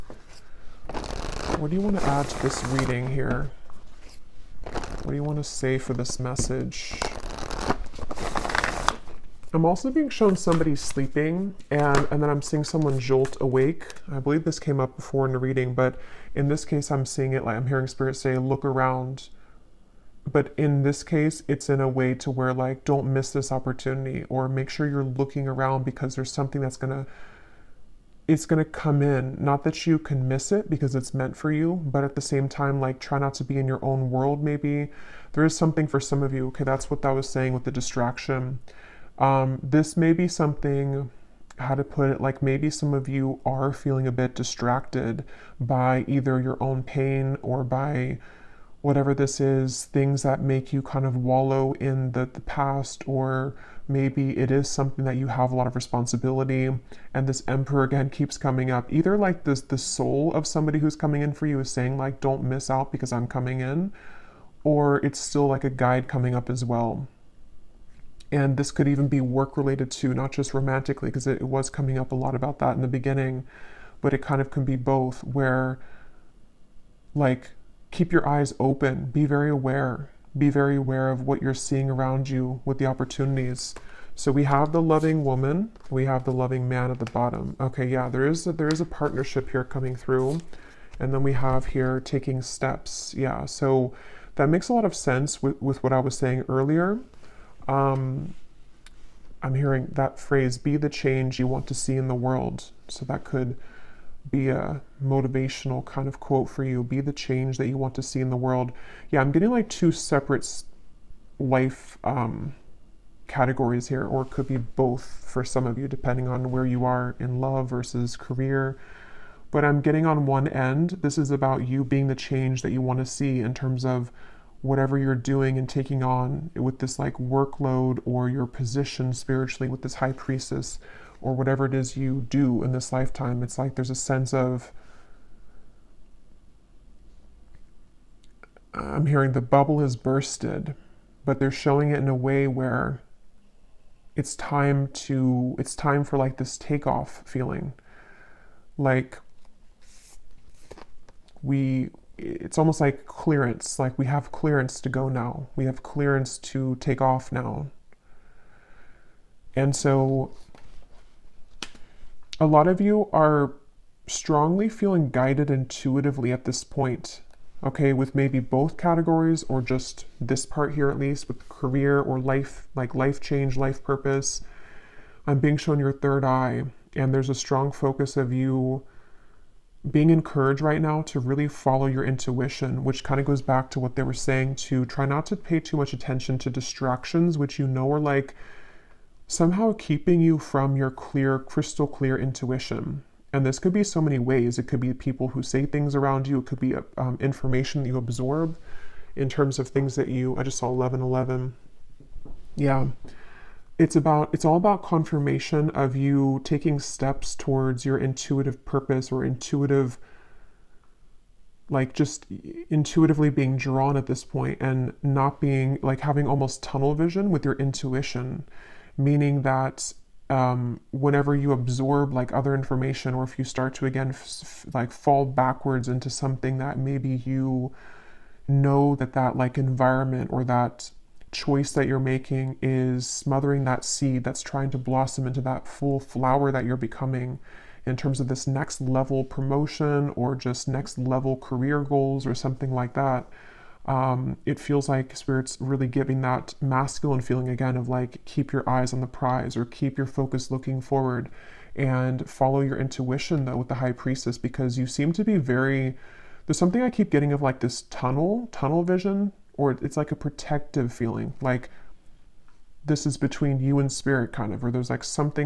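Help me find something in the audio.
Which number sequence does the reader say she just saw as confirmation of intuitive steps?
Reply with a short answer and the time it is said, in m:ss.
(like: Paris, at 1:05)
1111, at 3:20.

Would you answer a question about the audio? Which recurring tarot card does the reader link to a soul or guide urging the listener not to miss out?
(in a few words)
Emperor.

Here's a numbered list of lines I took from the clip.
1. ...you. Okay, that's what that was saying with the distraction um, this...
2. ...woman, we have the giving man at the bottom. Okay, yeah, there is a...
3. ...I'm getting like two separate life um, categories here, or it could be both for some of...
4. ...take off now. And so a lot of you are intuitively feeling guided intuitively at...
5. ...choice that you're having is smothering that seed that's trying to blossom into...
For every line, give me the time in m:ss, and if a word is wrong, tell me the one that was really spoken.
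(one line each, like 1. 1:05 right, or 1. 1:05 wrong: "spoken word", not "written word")
1. 0:36 right
2. 1:25 wrong: "loving", not "giving"
3. 1:49 right
4. 2:36 wrong: "strongly", not "intuitively"
5. 3:51 wrong: "making", not "having".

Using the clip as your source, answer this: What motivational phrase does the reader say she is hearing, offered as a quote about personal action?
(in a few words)
Be the change you want to see in the world.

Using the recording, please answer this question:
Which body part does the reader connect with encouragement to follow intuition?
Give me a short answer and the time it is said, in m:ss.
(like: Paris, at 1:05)
Third eye, at 2:55.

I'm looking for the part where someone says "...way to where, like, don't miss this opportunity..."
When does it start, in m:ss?
0:21.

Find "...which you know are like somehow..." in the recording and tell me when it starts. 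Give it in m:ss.
3:07.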